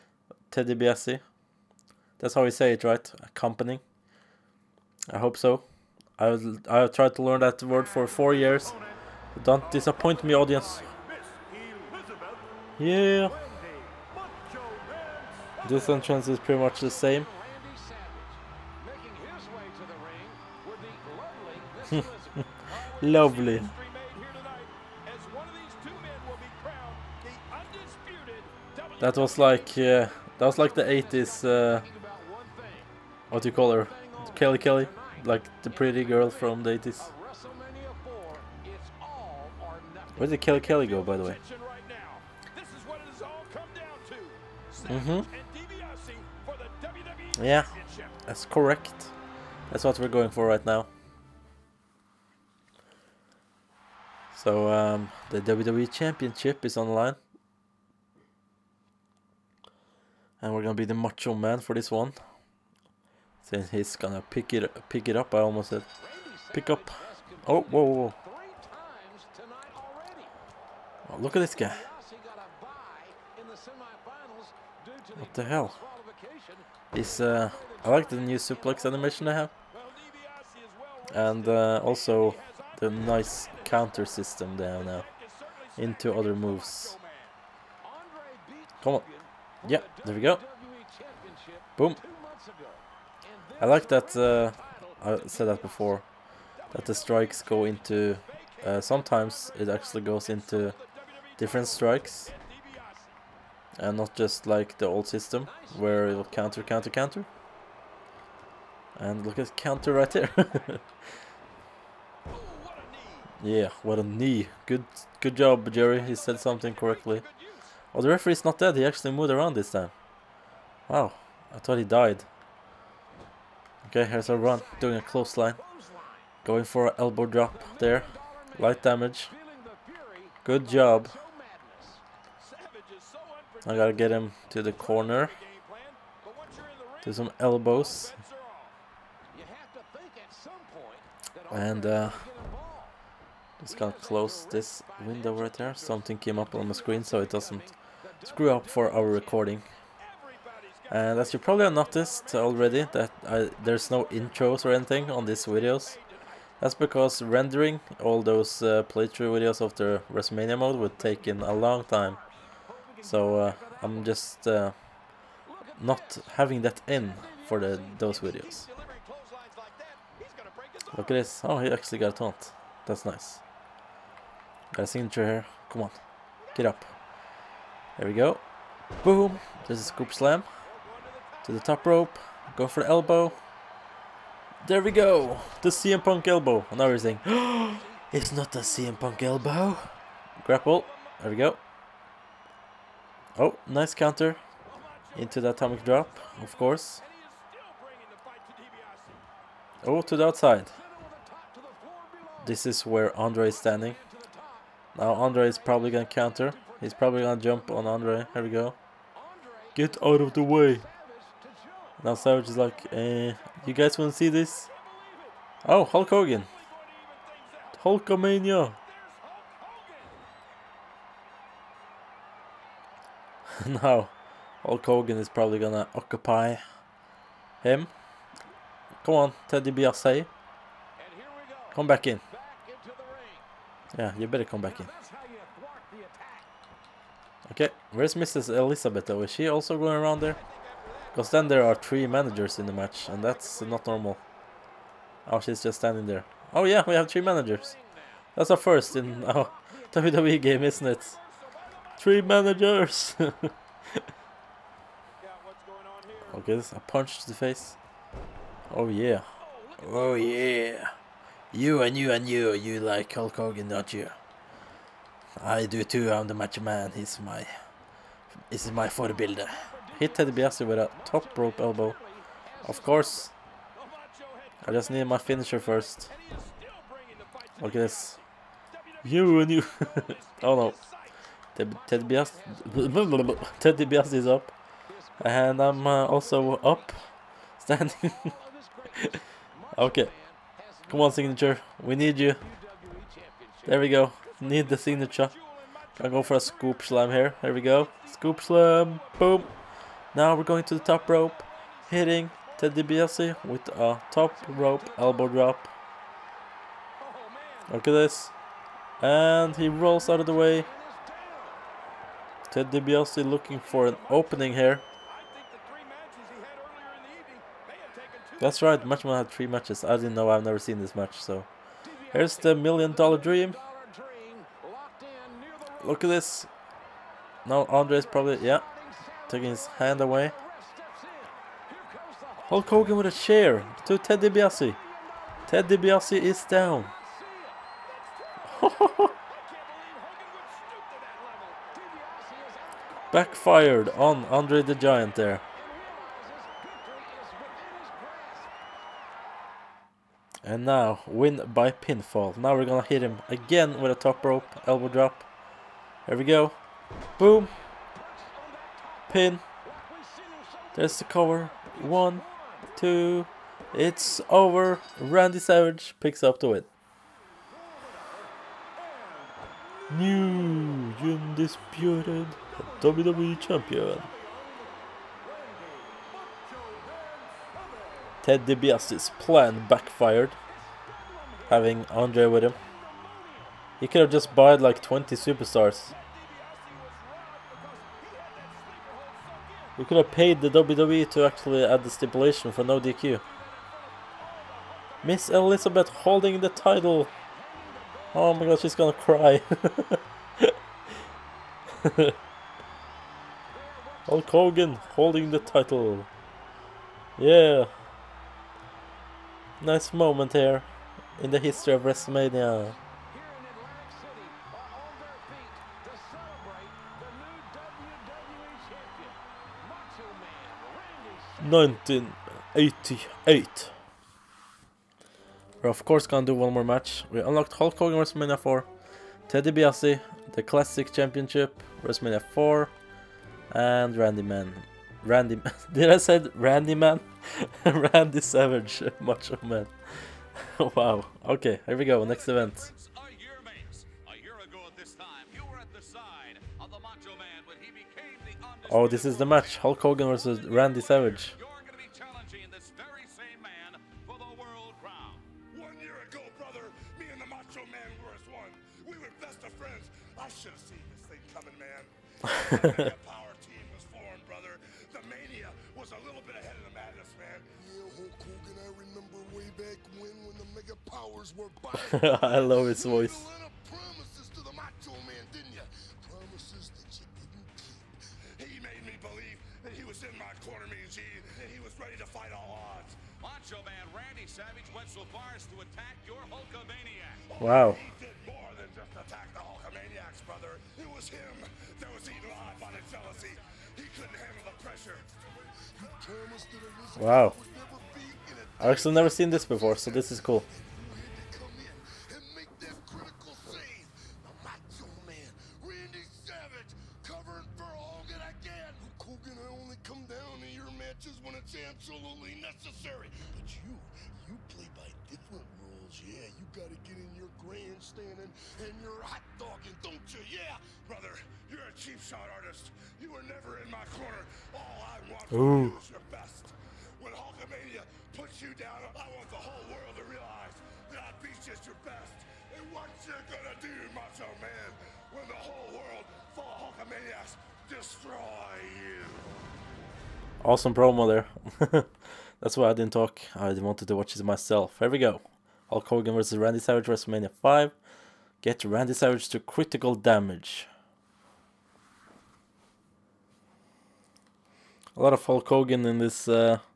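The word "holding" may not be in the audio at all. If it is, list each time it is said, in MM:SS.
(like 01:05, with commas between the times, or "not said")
06:35, 06:44.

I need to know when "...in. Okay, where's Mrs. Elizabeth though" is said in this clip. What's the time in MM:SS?
03:54.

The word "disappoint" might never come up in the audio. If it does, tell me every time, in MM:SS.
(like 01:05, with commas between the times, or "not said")
00:09.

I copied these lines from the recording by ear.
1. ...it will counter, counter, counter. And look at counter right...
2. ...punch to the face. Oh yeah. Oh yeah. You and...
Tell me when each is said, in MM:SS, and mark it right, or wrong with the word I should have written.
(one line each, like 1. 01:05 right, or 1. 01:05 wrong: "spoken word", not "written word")
1. 01:46 right
2. 04:16 right.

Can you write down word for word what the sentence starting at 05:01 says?
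Hitting Ted DiBiase with a top rope elbow drop.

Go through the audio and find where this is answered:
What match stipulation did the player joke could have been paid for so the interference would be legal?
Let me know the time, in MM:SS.
06:32.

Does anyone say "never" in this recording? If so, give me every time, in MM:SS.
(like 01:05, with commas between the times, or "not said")
05:20, 08:18.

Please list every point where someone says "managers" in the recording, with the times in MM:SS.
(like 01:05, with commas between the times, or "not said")
04:02, 04:07, 04:12.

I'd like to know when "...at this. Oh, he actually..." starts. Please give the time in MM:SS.
02:51.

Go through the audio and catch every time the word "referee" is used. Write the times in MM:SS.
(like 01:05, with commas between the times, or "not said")
01:58.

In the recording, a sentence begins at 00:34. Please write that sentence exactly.
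Kelly Kelly, like the pretty girl from the 80s.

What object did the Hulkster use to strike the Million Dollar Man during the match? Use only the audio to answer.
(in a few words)
a chair.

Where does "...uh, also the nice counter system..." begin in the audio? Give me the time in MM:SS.
01:21.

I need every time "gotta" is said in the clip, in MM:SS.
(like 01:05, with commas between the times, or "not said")
02:13, 02:23.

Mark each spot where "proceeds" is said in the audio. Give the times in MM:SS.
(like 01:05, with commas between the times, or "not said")
not said.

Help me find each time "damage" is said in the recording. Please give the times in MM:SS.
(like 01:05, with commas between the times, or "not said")
02:08, 09:09.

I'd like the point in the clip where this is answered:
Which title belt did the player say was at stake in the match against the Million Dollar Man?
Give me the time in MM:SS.
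00:55.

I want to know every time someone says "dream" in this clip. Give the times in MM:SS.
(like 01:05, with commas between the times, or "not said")
05:23.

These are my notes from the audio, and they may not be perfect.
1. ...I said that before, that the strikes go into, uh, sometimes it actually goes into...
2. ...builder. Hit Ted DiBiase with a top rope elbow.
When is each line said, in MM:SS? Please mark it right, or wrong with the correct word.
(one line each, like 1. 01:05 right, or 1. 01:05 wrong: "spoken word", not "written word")
1. 01:35 right
2. 04:28 right.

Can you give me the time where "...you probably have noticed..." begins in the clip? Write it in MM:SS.
02:31.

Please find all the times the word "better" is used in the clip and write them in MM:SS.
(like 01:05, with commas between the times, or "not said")
03:54.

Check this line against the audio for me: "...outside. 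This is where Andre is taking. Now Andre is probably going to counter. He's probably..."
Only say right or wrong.
wrong.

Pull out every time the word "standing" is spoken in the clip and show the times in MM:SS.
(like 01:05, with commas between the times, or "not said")
03:23, 04:05, 04:47.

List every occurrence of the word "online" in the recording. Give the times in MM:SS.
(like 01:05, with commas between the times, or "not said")
00:56.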